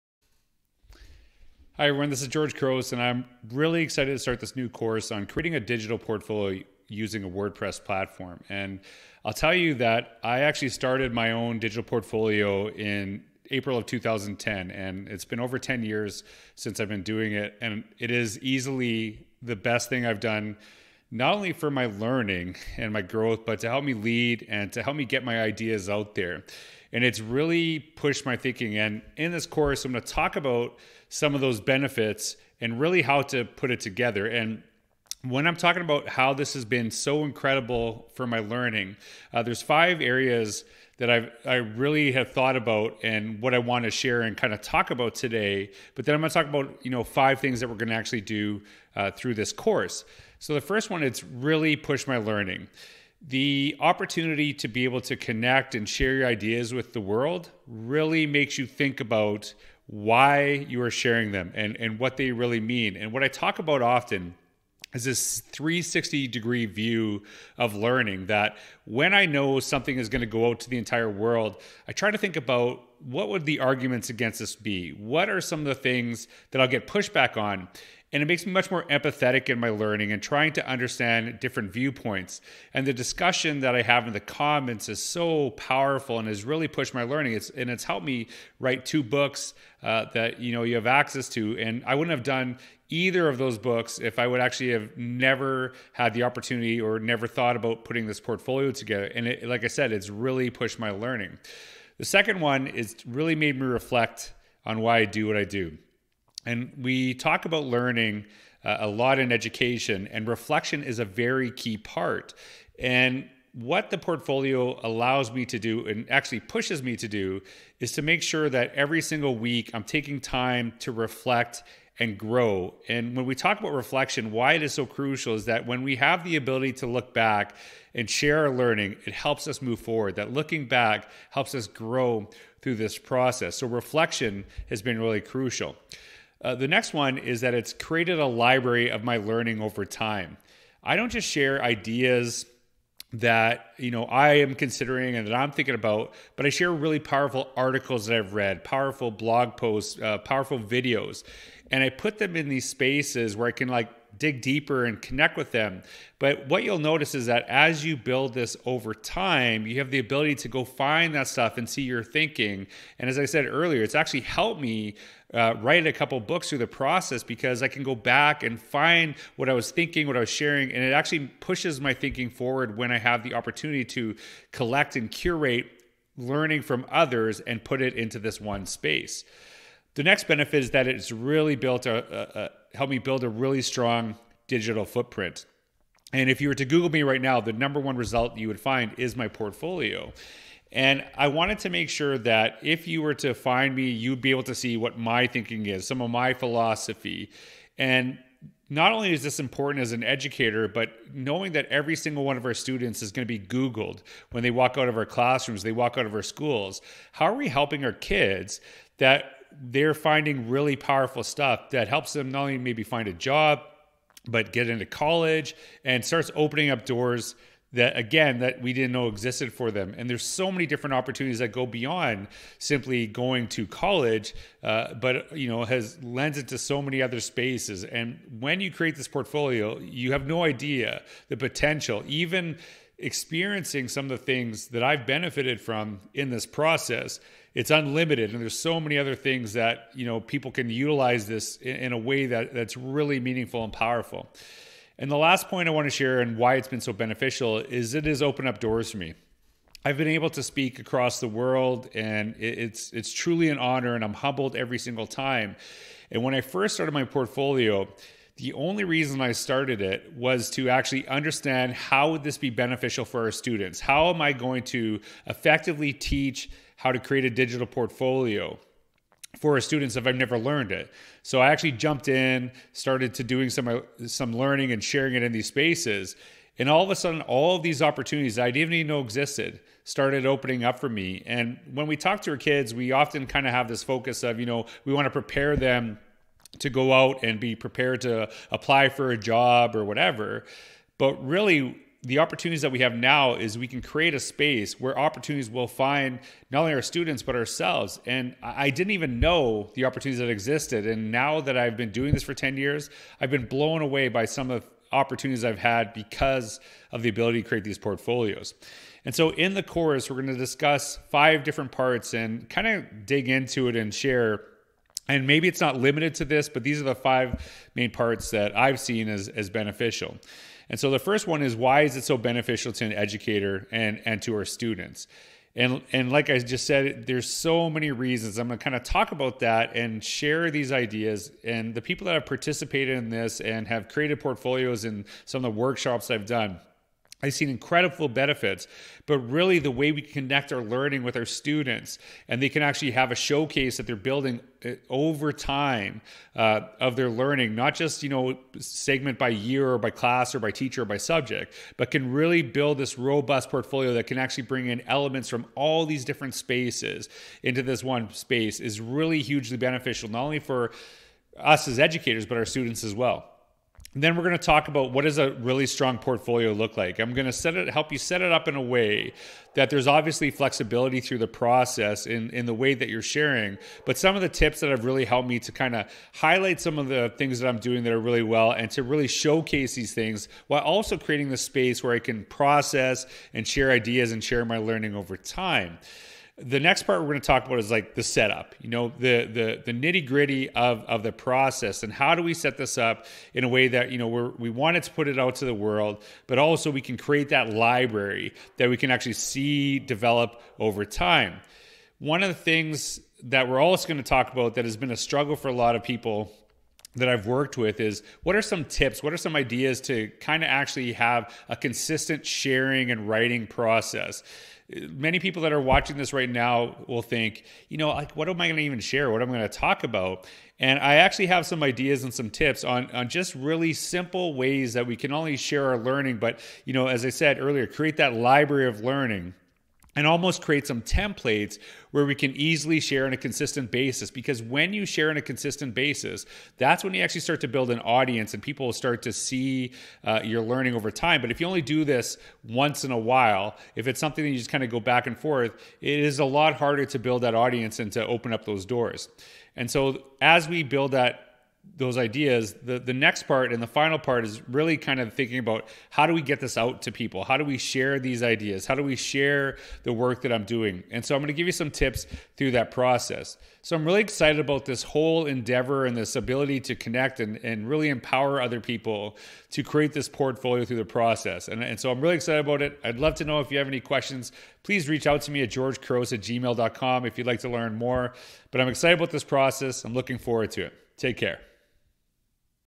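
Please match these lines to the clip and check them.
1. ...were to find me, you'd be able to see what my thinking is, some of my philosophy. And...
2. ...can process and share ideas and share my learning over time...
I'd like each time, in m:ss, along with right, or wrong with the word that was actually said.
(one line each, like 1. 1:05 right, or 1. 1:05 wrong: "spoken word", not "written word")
1. 3:13 right
2. 6:21 right.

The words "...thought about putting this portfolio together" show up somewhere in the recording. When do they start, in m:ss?
1:37.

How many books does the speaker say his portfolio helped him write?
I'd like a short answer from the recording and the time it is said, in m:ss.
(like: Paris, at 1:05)
2, at 1:28.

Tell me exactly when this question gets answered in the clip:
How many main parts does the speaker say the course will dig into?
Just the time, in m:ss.
5:11.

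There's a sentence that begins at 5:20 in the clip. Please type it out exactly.
And so the first one is why is it so beneficial to an educator and, and to our students?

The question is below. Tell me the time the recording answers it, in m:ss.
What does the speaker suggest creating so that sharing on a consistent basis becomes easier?
7:10.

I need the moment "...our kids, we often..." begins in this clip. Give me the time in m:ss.
4:42.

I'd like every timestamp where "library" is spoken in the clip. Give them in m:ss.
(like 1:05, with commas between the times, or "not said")
2:18, 6:37, 7:08.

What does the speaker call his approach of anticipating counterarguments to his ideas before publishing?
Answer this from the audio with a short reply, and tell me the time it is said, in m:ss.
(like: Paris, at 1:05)
360 degree view, at 1:05.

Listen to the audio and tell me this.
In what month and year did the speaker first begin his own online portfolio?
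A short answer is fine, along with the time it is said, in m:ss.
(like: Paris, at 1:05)
April 2010, at 0:13.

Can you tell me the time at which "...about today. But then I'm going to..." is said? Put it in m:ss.
0:44.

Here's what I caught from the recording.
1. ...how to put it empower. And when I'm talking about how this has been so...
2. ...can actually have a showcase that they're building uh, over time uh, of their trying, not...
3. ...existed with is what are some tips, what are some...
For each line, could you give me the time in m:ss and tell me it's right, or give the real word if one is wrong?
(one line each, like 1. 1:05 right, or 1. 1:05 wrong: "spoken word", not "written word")
1. 0:33 wrong: "together", not "empower"
2. 5:42 wrong: "learning", not "trying"
3. 6:47 wrong: "worked", not "existed".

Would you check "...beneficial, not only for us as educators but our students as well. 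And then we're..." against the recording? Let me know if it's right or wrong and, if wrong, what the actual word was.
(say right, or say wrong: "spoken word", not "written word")
right.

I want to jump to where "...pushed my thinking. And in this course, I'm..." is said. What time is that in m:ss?
0:27.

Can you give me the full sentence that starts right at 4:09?
I've been able to speak across the world, and it's it's truly an honor, and I'm humbled every single time.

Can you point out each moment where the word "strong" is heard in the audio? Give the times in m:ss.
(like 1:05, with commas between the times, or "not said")
3:03, 6:05.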